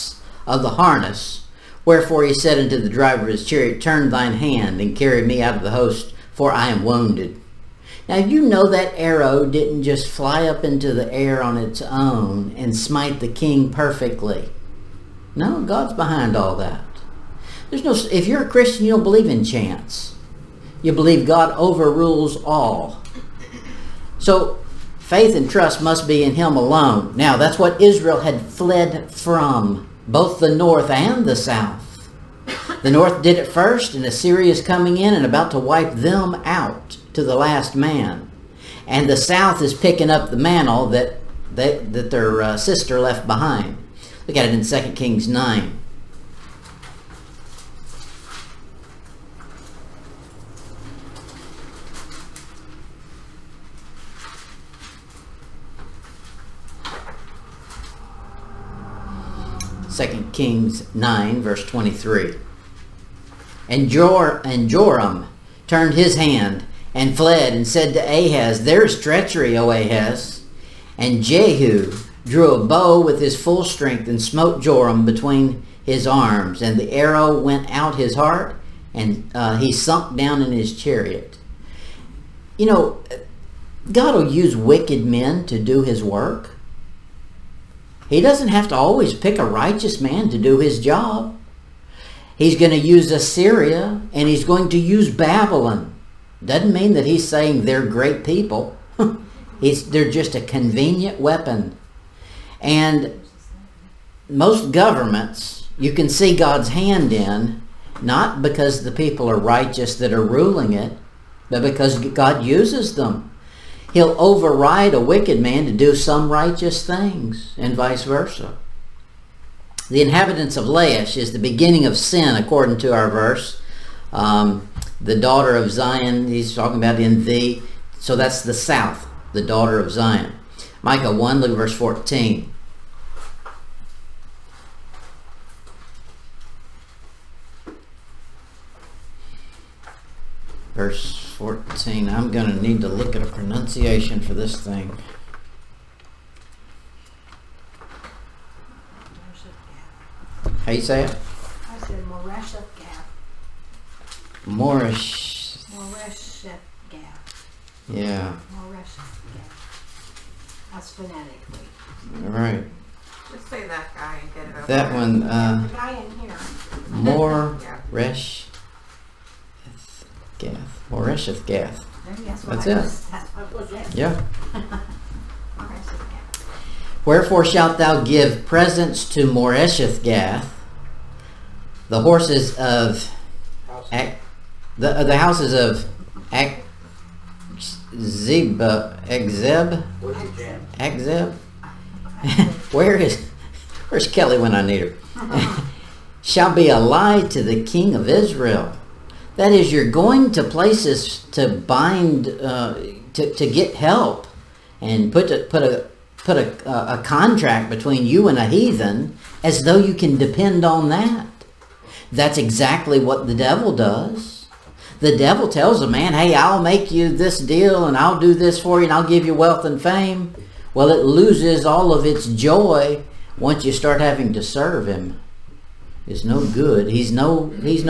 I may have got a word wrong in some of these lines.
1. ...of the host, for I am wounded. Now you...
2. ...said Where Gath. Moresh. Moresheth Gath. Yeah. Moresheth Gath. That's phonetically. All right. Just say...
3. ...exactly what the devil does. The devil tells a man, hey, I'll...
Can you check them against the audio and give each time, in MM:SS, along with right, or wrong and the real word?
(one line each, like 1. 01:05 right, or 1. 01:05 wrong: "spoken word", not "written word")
1. 00:05 right
2. 02:31 wrong: "Moresheth", not "Where"
3. 03:32 right.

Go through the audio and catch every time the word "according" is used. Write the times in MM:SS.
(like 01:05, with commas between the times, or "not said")
02:02.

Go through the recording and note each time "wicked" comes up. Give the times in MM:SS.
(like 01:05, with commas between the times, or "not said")
01:24, 01:55.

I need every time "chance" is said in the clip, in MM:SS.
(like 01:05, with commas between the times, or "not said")
00:19.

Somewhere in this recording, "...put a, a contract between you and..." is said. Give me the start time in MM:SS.
03:26.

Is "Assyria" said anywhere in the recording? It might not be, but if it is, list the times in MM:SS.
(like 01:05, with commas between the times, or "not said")
00:34, 01:33.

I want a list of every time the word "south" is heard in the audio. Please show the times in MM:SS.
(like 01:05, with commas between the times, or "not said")
00:31, 00:39, 02:08.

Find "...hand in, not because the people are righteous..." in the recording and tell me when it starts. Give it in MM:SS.
01:46.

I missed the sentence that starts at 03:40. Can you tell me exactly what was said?
Well, it loses all of its joy once you start having to serve him.